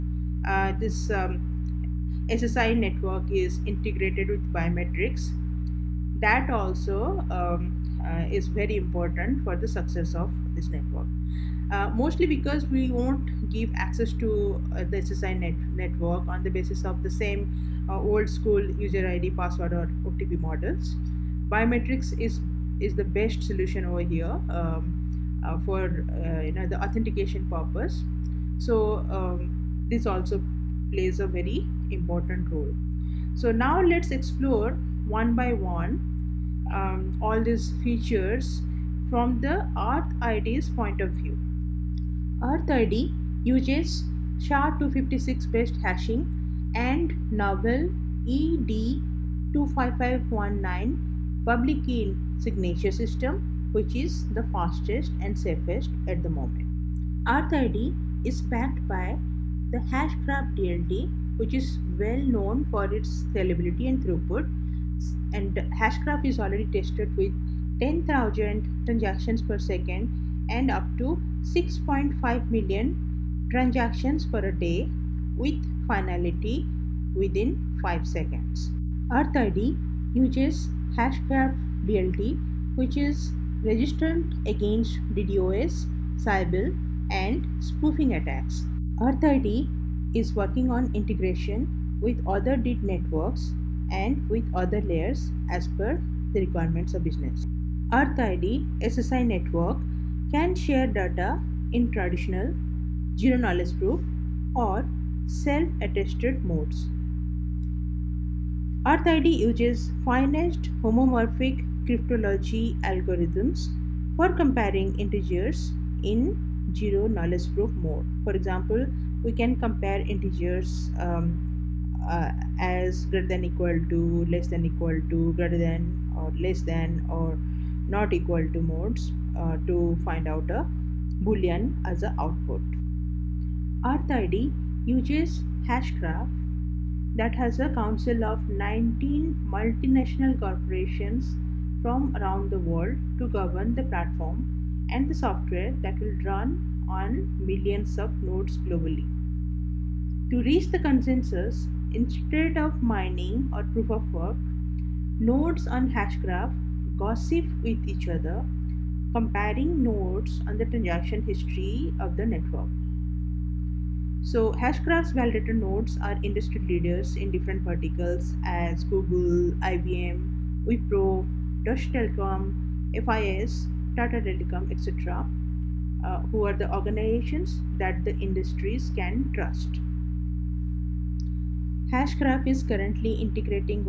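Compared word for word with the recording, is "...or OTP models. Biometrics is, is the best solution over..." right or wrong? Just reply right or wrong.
right.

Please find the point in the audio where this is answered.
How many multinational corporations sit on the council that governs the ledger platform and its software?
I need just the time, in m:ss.
2:18.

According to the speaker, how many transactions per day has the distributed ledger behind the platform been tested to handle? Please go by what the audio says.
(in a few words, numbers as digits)
6.5 million.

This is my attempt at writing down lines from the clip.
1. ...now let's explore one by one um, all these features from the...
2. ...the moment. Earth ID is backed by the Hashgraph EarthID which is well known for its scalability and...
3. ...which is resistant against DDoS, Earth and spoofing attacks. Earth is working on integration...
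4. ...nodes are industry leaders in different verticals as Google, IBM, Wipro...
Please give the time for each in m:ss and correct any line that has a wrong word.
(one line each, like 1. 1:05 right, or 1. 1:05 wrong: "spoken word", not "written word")
1. 0:33 right
2. 0:56 wrong: "DLT", not "EarthID"
3. 1:22 wrong: "Sybil", not "Earth"
4. 2:45 right.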